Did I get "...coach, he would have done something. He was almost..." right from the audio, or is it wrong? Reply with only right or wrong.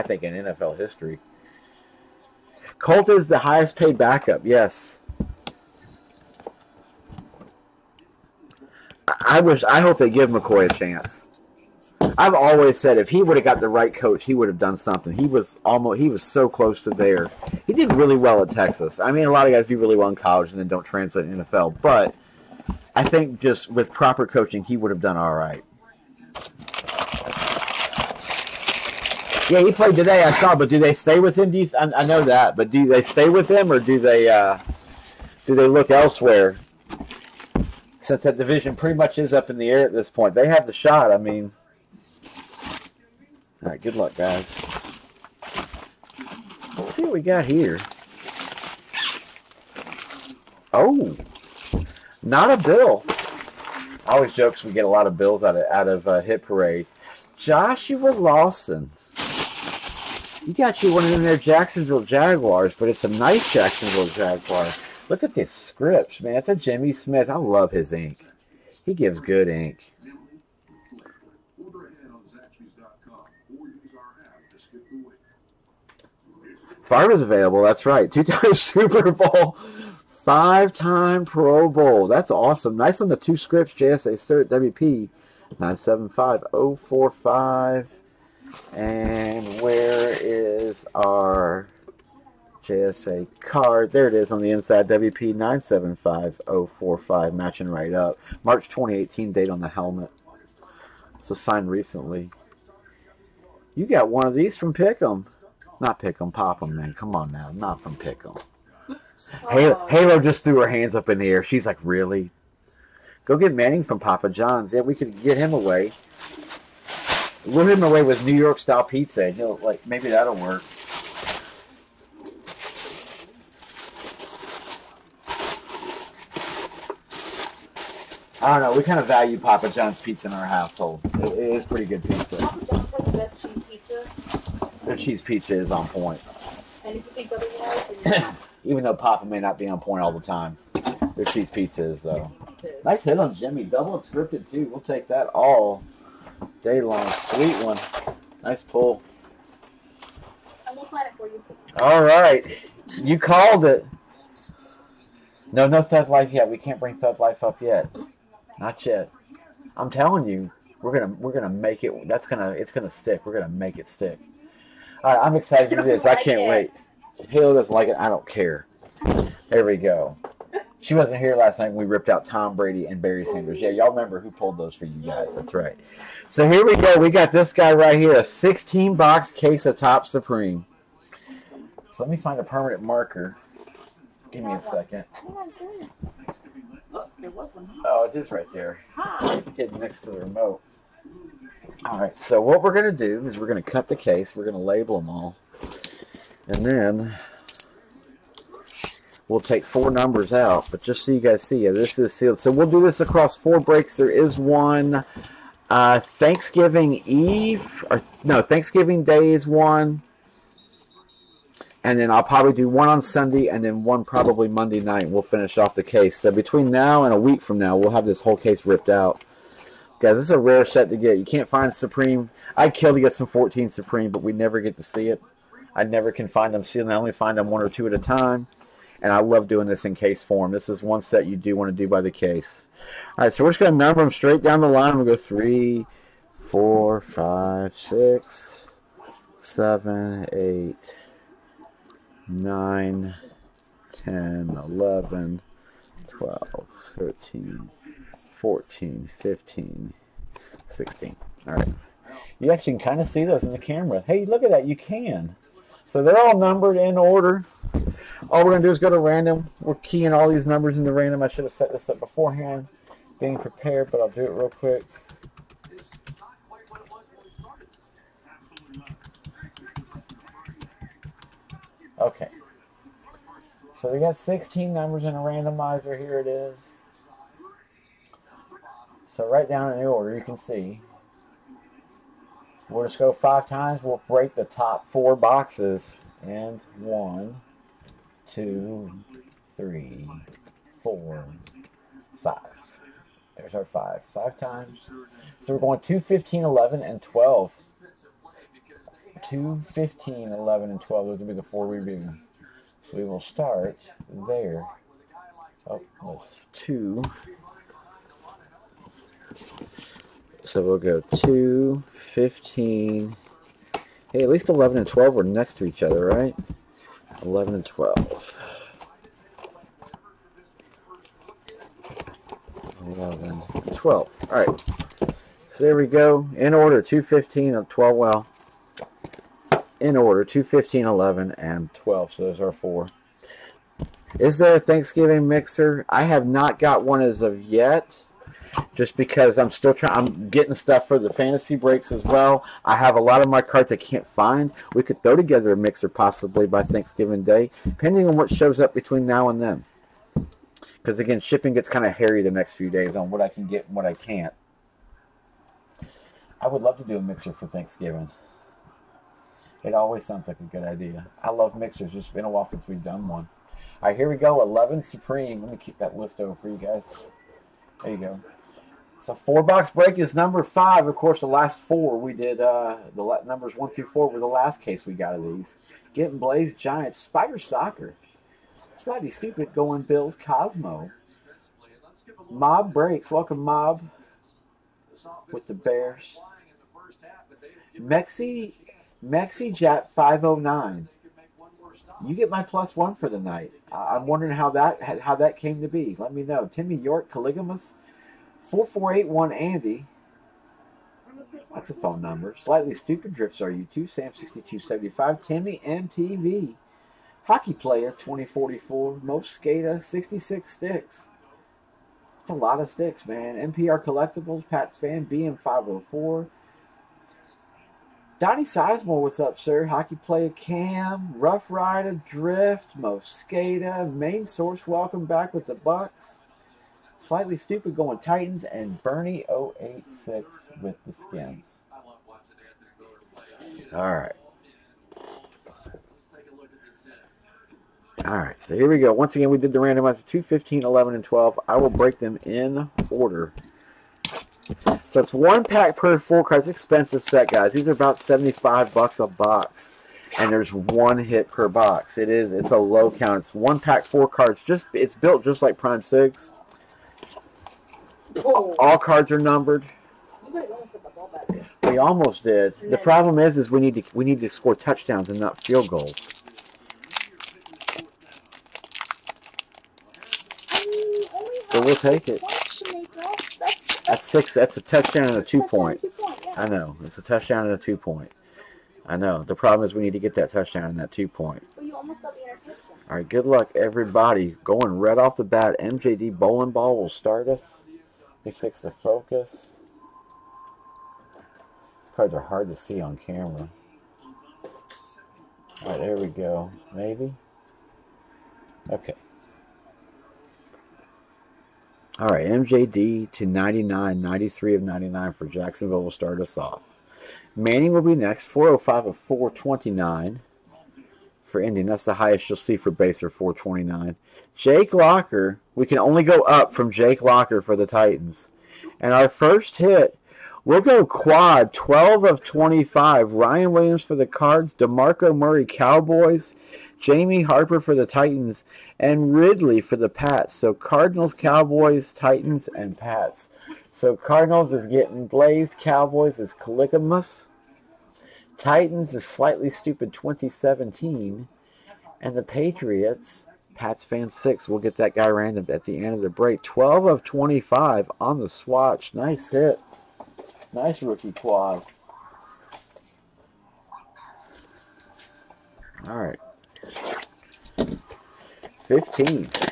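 right.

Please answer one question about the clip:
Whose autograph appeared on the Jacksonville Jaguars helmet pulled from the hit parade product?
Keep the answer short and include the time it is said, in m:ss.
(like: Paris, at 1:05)
Jimmy Smith, at 1:06.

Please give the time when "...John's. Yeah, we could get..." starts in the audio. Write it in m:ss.
1:54.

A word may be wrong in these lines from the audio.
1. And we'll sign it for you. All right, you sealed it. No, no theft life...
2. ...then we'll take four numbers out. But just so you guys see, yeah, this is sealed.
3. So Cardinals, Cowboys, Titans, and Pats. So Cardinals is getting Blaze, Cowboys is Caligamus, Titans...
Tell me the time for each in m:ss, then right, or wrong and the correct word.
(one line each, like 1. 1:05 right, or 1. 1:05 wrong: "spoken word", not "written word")
1. 2:30 wrong: "called", not "sealed"
2. 3:16 right
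3. 8:50 right.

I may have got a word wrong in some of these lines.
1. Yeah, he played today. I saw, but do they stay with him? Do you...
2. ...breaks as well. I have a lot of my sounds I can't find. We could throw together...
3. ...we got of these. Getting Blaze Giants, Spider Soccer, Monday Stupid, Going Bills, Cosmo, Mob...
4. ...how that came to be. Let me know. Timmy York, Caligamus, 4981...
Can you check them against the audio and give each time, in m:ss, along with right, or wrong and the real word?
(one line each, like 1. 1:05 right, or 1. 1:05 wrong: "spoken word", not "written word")
1. 0:29 right
2. 5:41 wrong: "cards", not "sounds"
3. 6:14 wrong: "Slightly", not "Monday"
4. 6:34 wrong: "4481", not "4981".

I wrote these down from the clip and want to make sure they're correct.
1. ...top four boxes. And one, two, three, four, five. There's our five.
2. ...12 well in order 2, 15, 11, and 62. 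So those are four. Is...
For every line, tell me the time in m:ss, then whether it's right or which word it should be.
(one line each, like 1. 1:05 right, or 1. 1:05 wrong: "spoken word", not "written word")
1. 4:44 right
2. 5:27 wrong: "12", not "62".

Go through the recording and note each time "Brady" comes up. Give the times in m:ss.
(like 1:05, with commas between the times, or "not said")
2:52.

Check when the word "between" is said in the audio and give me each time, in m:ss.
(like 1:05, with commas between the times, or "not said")
3:36, 5:48.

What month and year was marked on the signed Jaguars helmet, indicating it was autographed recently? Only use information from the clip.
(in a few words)
March 2018.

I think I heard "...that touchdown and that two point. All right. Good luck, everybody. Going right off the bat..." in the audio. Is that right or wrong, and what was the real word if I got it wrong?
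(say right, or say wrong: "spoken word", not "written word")
right.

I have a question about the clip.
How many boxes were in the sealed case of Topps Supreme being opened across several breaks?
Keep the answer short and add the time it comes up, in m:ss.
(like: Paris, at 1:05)
16, at 2:58.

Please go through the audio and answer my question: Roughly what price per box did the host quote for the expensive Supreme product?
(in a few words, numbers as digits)
$75.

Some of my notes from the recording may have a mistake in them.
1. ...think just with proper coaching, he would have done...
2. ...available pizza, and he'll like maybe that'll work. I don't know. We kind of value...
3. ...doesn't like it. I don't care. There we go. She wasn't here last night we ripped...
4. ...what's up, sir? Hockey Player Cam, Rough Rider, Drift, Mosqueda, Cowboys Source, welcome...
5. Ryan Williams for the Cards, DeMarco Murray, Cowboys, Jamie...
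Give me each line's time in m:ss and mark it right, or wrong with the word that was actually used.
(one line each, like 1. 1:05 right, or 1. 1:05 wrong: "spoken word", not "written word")
1. 0:23 right
2. 1:58 wrong: "style", not "available"
3. 2:47 right
4. 6:59 wrong: "Main", not "Cowboys"
5. 8:43 right.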